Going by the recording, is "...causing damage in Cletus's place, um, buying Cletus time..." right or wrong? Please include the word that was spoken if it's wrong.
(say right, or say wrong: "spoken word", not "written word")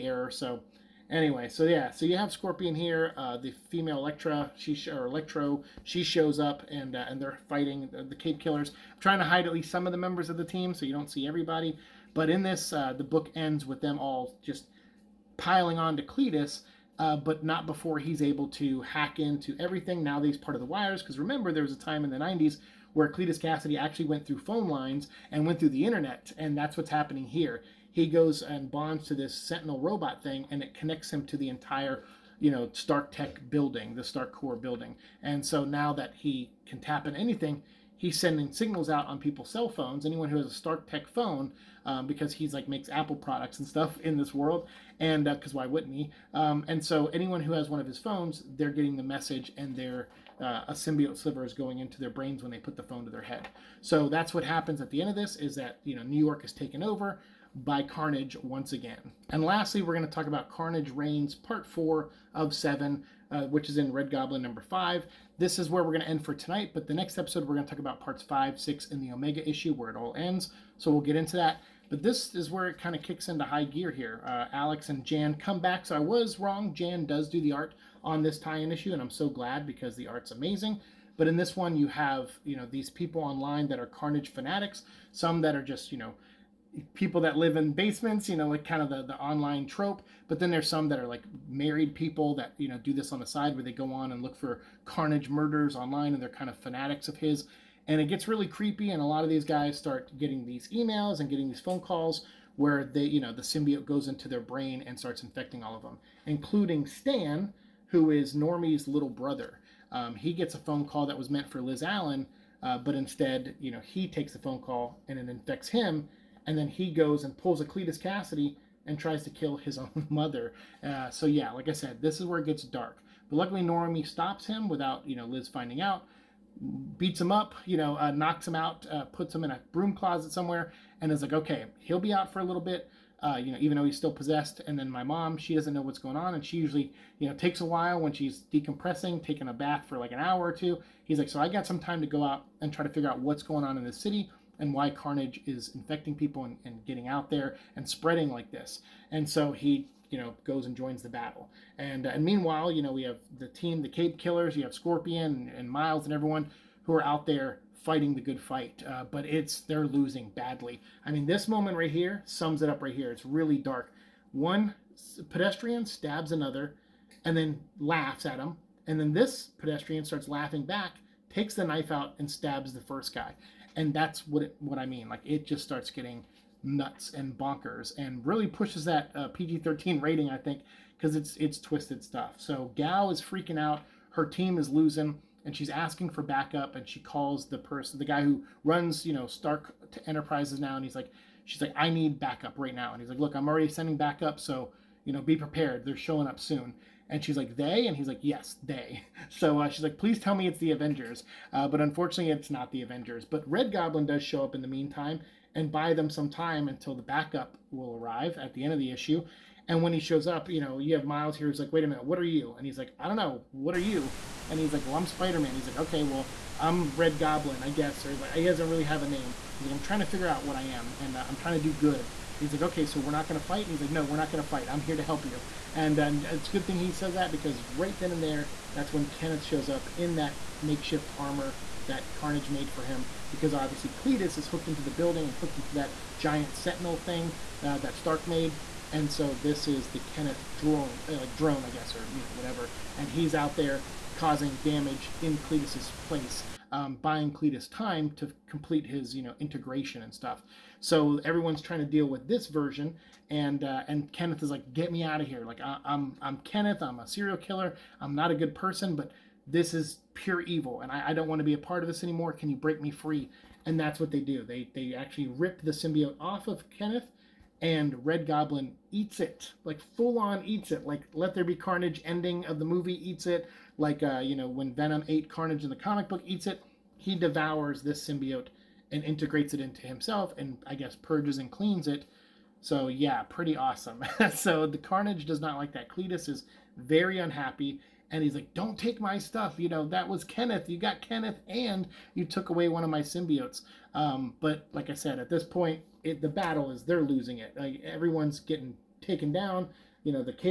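right.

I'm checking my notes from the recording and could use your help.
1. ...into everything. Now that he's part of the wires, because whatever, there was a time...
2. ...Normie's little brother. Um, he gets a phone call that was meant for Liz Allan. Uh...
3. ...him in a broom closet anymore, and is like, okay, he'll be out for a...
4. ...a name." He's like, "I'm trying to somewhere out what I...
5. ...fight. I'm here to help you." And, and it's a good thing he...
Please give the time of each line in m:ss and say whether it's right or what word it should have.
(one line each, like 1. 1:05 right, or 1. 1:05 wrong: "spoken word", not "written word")
1. 0:19 wrong: "remember", not "whatever"
2. 1:48 right
3. 2:09 wrong: "somewhere", not "anymore"
4. 3:39 wrong: "figure", not "somewhere"
5. 3:44 right.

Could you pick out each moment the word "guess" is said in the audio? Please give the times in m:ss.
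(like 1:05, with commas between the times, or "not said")
3:37, 4:01, 4:40.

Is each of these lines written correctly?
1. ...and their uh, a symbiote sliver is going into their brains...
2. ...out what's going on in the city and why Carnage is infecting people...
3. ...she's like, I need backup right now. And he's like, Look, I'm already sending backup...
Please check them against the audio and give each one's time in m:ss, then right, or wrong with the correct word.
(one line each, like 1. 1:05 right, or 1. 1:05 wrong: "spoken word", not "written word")
1. 0:49 right
2. 2:23 right
3. 3:11 right.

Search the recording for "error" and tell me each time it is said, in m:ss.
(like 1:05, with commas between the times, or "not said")
0:00.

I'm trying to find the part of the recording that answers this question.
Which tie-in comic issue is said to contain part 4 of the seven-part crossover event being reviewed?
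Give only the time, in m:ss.
1:03.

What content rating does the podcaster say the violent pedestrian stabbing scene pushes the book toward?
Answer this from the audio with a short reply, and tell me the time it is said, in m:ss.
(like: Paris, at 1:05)
PG-13, at 2:59.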